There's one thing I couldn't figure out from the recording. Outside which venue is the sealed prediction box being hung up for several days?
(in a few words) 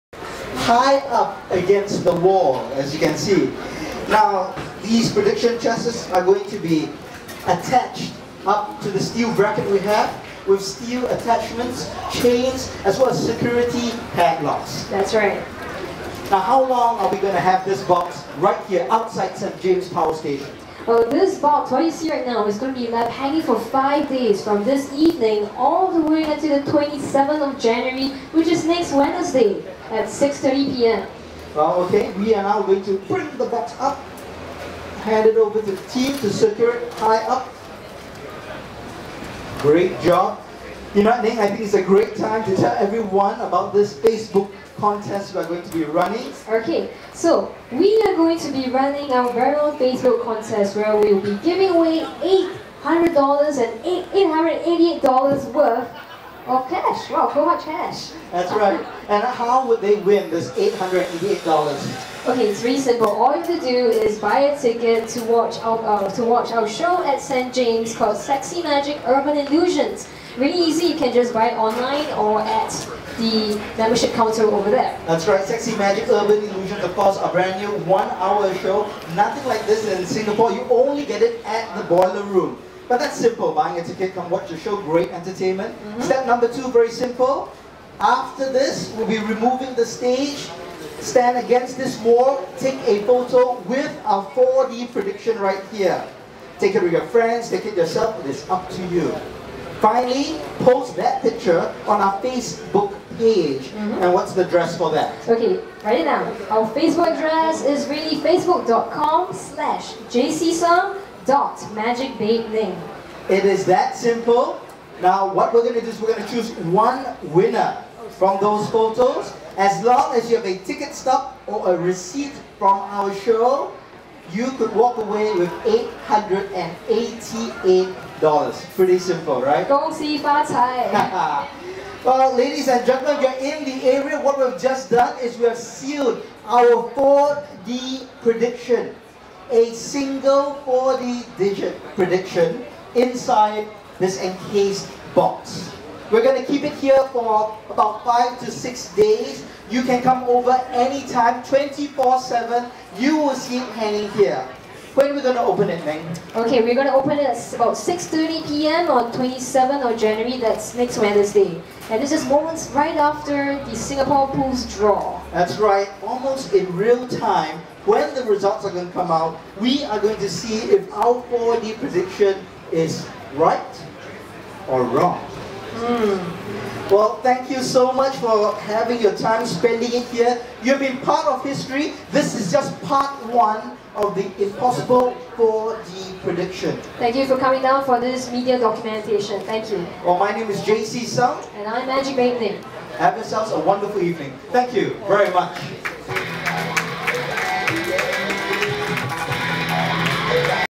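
St. James Power Station.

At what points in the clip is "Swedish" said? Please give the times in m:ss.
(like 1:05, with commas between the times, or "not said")
not said.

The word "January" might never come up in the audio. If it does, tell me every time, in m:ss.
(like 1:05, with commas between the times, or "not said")
0:27, 2:39.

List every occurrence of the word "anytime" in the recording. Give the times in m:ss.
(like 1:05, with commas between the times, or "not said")
2:30.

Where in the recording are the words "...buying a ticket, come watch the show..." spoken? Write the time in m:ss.
1:23.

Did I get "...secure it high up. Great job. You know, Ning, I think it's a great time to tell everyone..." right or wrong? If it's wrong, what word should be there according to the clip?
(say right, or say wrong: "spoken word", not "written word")
right.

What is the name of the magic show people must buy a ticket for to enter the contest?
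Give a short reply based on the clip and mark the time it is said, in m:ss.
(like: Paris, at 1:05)
Sexy Magic Urban Illusions, at 1:08.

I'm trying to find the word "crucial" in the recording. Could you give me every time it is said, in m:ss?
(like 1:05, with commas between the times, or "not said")
not said.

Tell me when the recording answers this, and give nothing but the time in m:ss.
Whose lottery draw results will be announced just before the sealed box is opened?
2:43.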